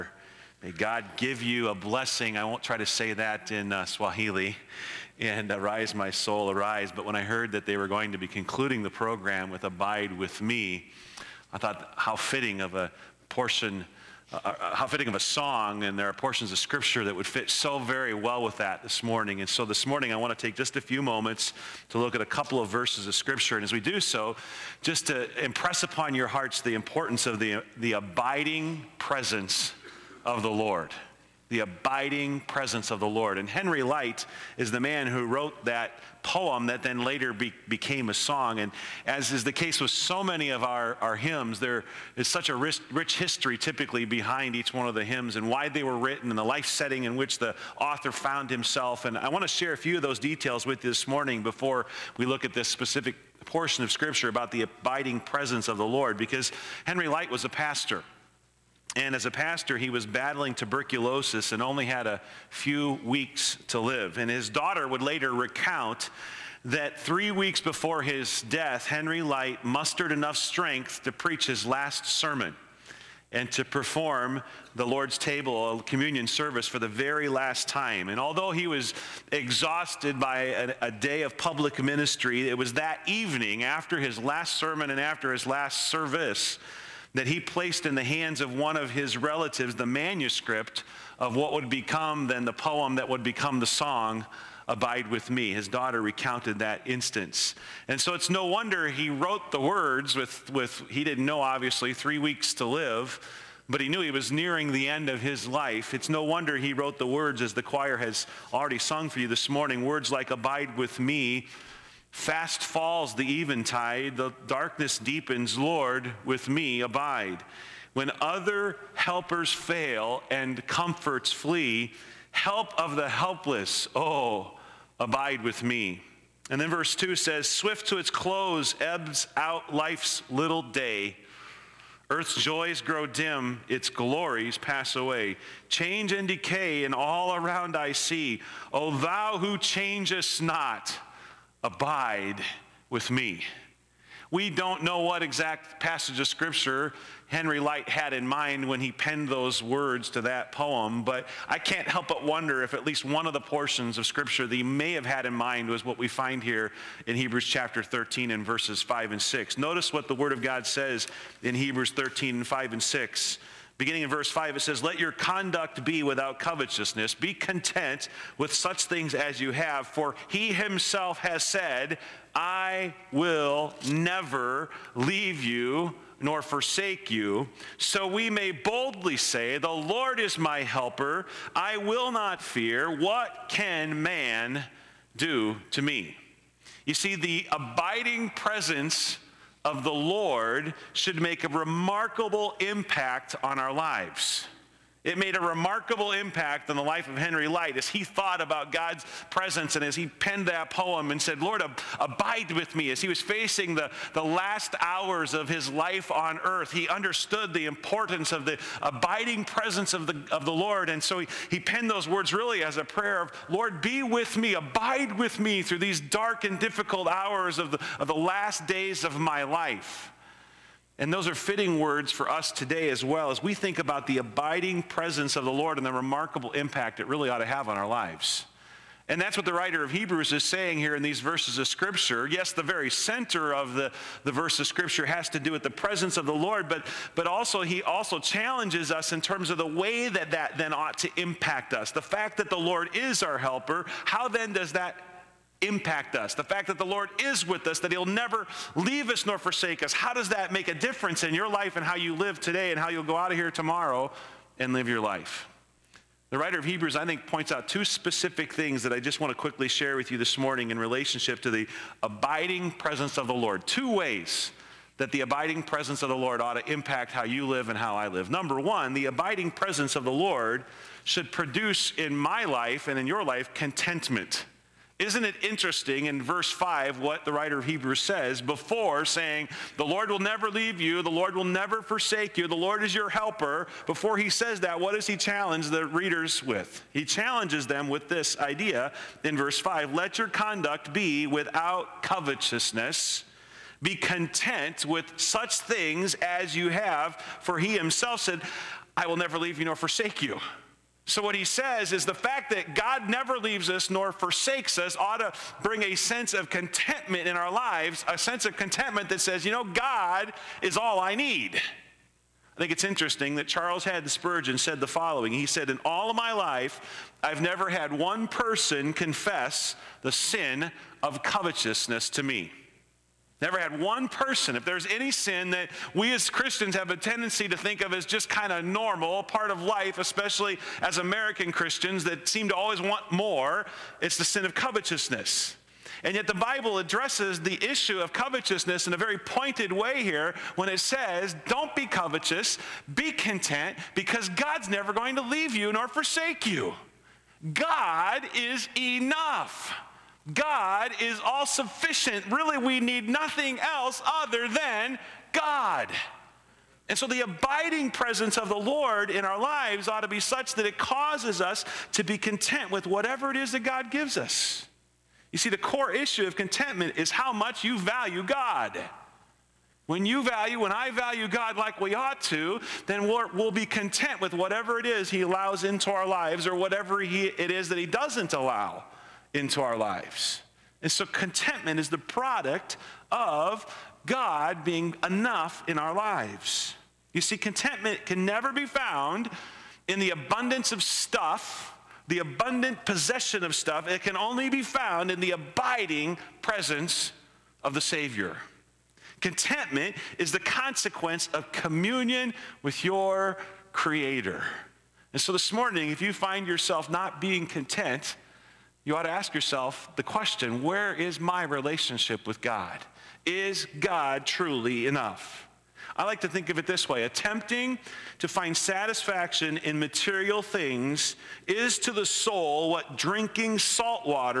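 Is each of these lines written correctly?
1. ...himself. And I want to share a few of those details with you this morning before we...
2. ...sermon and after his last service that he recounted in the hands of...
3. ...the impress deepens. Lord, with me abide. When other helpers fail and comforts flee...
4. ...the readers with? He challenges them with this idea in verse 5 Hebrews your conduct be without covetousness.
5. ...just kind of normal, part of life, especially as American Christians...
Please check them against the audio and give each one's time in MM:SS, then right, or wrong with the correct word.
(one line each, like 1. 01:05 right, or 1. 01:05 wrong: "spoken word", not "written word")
1. 00:48 right
2. 01:24 wrong: "placed", not "recounted"
3. 01:54 wrong: "darkness", not "impress"
4. 04:45 wrong: "Let", not "Hebrews"
5. 05:28 right.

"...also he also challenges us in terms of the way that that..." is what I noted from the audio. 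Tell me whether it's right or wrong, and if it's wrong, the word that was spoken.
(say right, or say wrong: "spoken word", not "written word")
right.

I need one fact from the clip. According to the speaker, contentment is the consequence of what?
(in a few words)
Communion with your Creator.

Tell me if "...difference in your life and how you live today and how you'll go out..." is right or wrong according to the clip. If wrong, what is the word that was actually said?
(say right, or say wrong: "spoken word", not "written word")
right.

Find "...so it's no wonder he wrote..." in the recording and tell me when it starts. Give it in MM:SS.
01:37.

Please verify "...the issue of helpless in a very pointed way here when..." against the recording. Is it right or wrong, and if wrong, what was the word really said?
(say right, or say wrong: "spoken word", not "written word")
wrong: "covetousness", not "helpless".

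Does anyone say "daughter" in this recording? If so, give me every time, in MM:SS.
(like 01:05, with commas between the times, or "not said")
01:04, 01:35.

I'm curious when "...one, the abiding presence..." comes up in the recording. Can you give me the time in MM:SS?
04:28.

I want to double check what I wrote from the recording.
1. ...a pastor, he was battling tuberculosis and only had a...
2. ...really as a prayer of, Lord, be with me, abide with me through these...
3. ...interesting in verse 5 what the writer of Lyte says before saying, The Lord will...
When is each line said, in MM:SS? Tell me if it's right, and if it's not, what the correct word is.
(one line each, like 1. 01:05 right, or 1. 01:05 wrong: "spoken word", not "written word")
1. 00:59 right
2. 03:32 right
3. 04:35 wrong: "Hebrews", not "Lyte".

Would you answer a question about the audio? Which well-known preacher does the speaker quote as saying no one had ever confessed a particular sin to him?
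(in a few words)
Charles Haddon Spurgeon.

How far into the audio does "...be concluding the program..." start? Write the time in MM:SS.
00:08.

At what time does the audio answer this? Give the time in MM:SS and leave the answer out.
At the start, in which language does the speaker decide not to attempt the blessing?
00:03.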